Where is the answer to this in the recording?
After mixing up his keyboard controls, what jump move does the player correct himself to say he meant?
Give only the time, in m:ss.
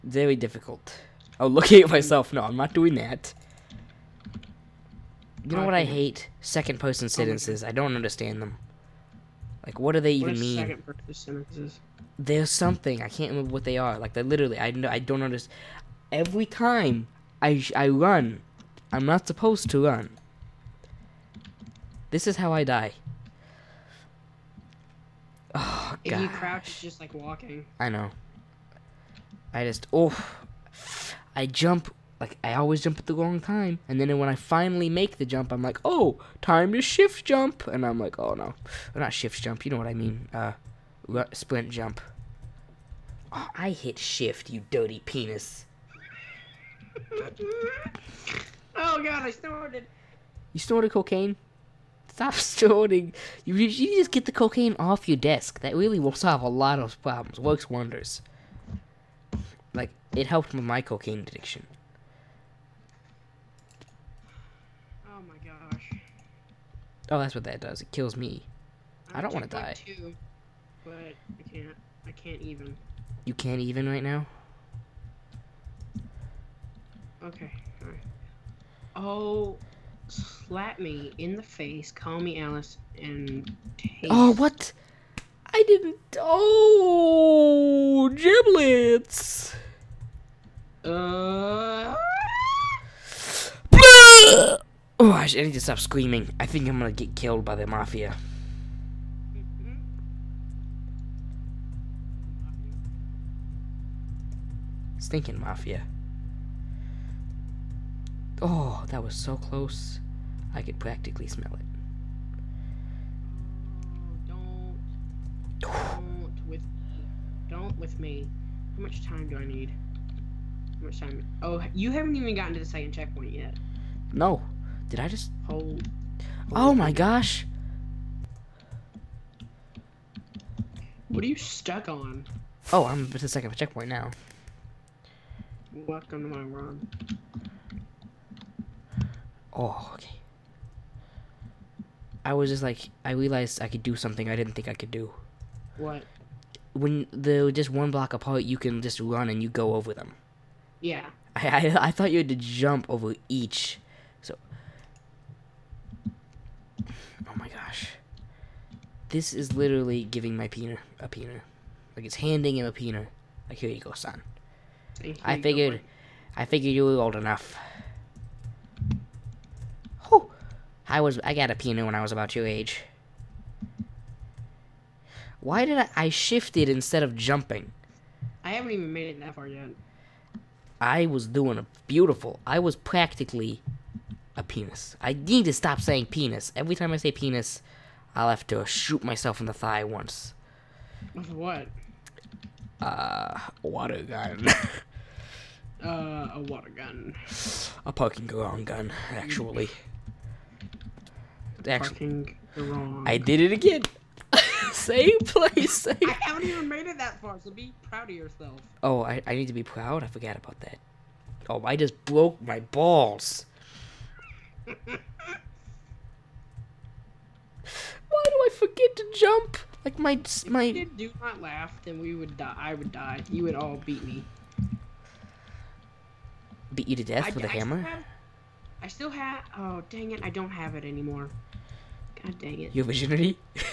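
0:41.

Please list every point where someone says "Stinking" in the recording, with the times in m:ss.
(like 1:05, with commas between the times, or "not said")
1:44.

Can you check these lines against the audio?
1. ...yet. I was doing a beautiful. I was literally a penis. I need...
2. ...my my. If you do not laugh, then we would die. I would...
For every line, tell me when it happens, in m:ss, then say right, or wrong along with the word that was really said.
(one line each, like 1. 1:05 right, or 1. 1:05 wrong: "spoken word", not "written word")
1. 2:59 wrong: "practically", not "literally"
2. 3:39 right.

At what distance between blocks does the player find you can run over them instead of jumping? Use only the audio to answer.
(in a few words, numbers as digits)
1 block.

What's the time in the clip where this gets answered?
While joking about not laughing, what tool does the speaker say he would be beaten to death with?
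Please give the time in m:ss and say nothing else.
3:47.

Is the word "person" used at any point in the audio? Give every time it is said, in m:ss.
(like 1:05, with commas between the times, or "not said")
0:06, 0:10.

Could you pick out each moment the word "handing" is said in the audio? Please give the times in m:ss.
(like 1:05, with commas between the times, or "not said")
2:42.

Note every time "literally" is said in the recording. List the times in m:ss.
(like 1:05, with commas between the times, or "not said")
0:14, 2:39.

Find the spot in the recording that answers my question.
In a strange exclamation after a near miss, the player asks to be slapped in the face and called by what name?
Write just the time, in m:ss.
1:22.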